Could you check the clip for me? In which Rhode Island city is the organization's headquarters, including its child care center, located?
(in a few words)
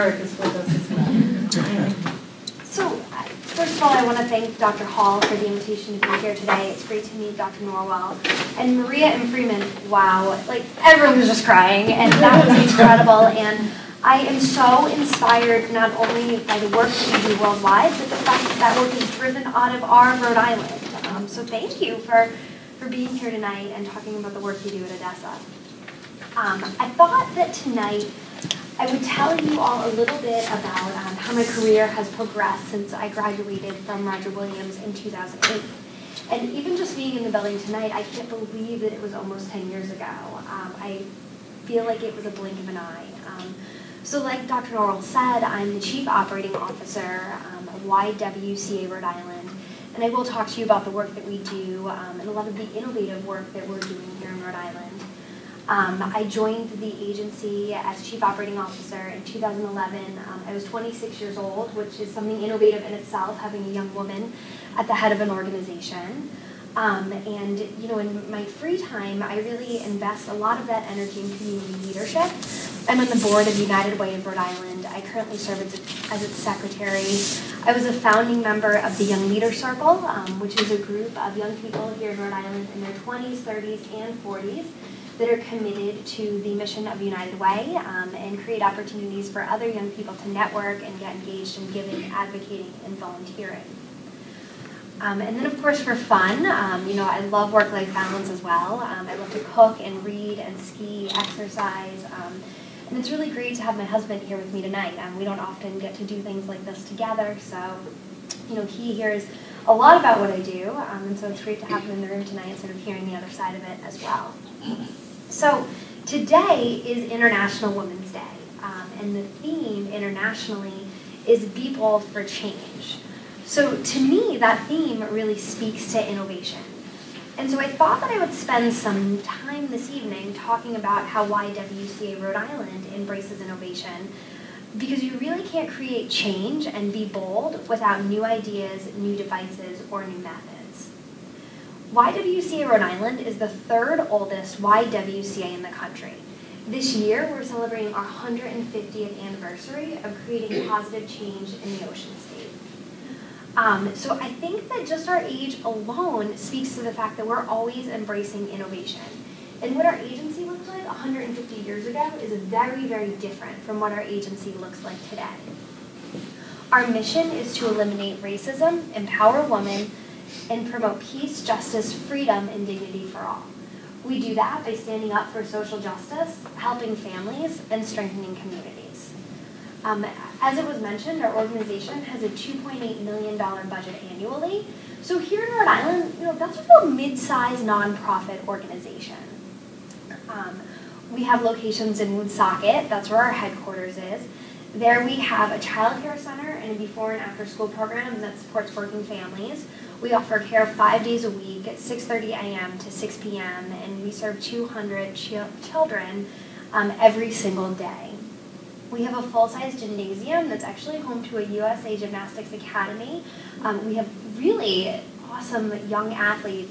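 Woonsocket.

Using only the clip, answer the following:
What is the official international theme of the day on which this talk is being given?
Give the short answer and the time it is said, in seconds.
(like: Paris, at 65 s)
Be Bold for Change, at 121 s.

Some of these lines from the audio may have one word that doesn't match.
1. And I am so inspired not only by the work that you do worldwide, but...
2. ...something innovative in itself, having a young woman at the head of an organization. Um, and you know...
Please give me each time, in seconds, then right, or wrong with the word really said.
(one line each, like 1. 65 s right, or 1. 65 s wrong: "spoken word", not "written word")
1. 13 s right
2. 62 s right.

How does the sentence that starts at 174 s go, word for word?
We do that by standing up for social justice, helping families, and strengthening communities.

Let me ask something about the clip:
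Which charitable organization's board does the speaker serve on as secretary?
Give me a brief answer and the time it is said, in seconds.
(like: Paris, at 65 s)
United Way of Rhode Island, at 73 s.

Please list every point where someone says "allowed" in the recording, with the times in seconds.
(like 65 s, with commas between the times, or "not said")
not said.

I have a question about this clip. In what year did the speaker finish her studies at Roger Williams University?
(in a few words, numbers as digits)
2008.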